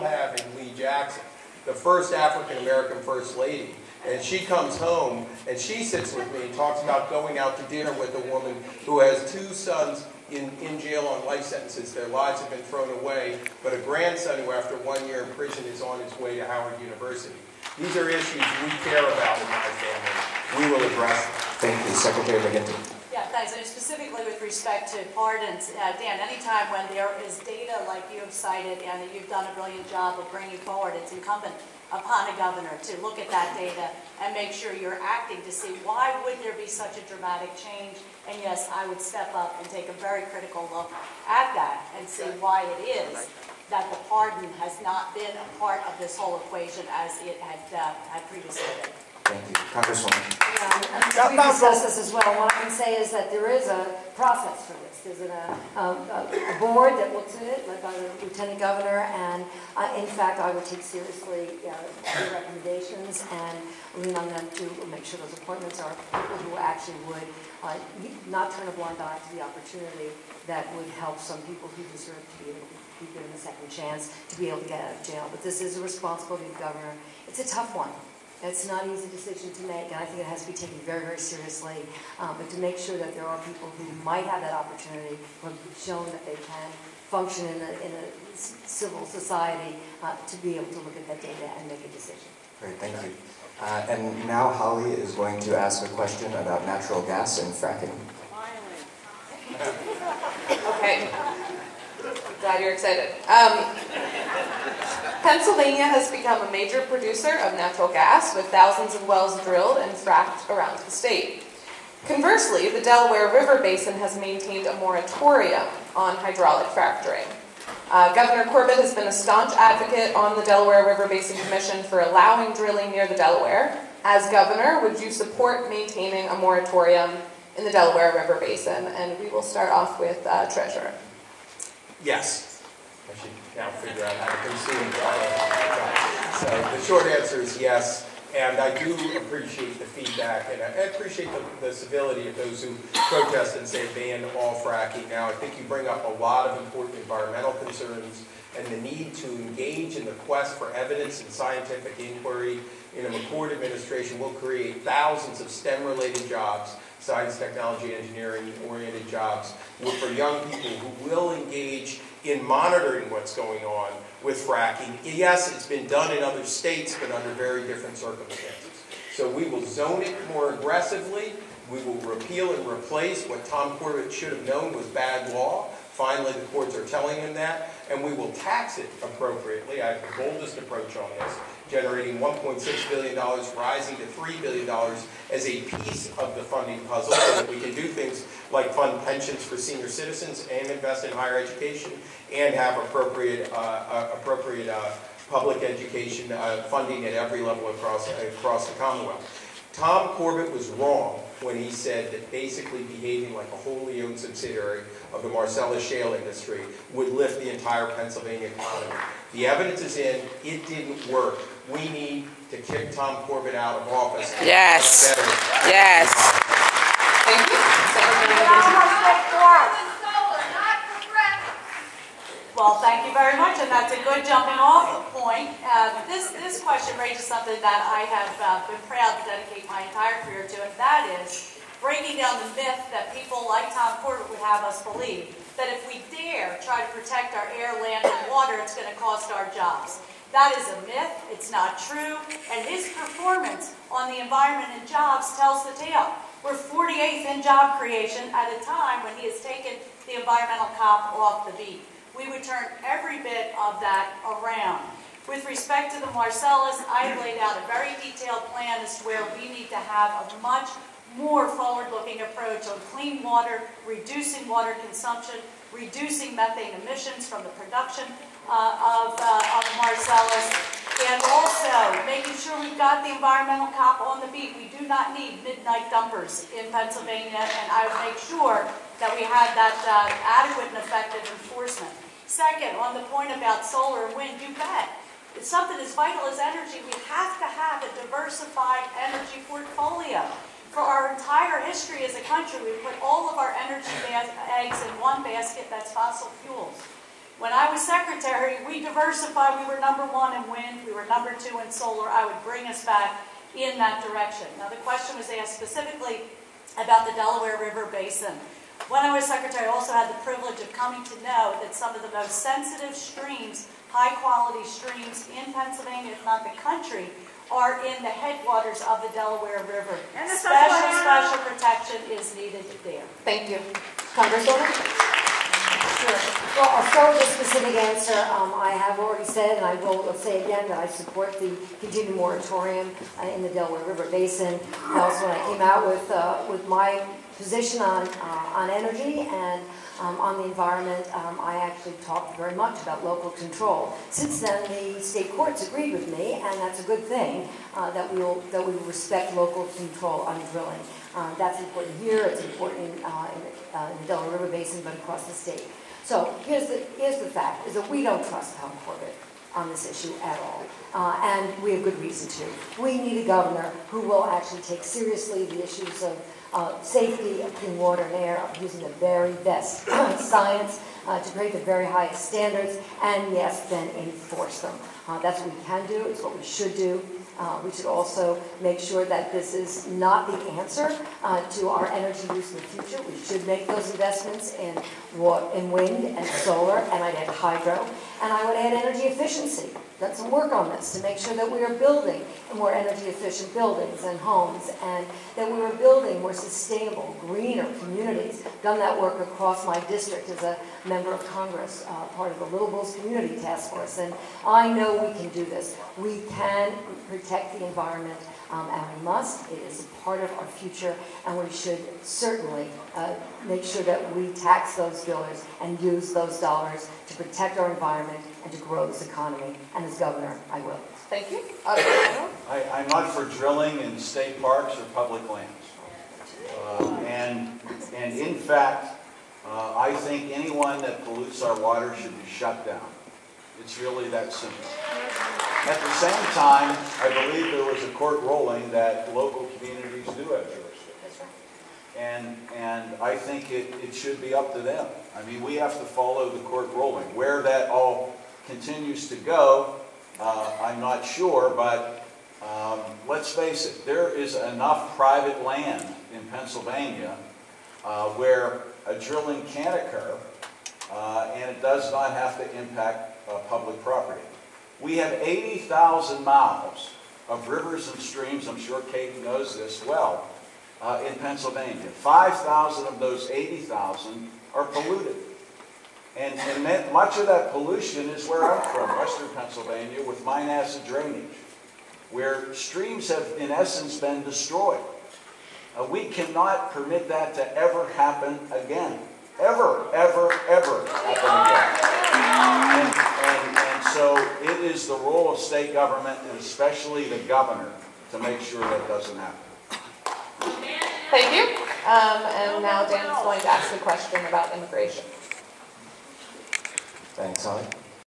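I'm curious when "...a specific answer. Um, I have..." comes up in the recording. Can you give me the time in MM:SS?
05:27.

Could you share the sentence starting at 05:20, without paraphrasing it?
special, special protection is needed there.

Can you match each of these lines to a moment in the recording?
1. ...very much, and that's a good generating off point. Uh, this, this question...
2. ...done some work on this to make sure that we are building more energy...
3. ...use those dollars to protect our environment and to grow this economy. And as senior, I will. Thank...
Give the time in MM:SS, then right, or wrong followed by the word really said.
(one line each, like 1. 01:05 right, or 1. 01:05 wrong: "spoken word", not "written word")
1. 03:43 wrong: "jumping", not "generating"
2. 06:29 right
3. 06:55 wrong: "governor", not "senior".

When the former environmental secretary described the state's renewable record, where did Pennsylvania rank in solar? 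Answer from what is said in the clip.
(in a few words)
number two.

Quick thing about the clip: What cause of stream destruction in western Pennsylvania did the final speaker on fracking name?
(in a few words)
mine acid drainage.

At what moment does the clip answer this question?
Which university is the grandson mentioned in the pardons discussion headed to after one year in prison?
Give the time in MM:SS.
00:16.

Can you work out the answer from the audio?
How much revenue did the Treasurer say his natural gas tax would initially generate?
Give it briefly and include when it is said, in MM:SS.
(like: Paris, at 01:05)
$1.6 billion, at 03:02.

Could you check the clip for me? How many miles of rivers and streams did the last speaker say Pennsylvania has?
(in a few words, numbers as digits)
80,000.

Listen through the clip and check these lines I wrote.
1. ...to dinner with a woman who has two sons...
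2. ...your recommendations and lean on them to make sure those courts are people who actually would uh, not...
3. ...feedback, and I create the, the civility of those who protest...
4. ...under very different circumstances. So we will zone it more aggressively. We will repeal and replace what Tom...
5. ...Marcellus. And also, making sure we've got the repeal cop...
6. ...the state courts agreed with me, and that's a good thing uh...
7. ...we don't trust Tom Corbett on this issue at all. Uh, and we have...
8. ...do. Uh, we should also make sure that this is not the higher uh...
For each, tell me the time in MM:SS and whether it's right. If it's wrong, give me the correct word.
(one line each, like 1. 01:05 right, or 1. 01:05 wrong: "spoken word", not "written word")
1. 00:07 right
2. 01:02 wrong: "appointments", not "courts"
3. 02:19 wrong: "appreciate", not "create"
4. 02:47 right
5. 04:29 wrong: "environmental", not "repeal"
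6. 05:44 right
7. 05:57 right
8. 06:16 wrong: "answer", not "higher".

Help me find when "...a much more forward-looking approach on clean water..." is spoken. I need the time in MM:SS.
04:20.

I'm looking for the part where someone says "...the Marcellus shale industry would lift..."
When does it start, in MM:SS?
03:25.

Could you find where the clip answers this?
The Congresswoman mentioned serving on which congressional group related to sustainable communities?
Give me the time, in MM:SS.
06:42.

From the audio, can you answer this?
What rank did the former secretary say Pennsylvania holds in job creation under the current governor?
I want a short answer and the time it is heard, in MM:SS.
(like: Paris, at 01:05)
48th, at 04:06.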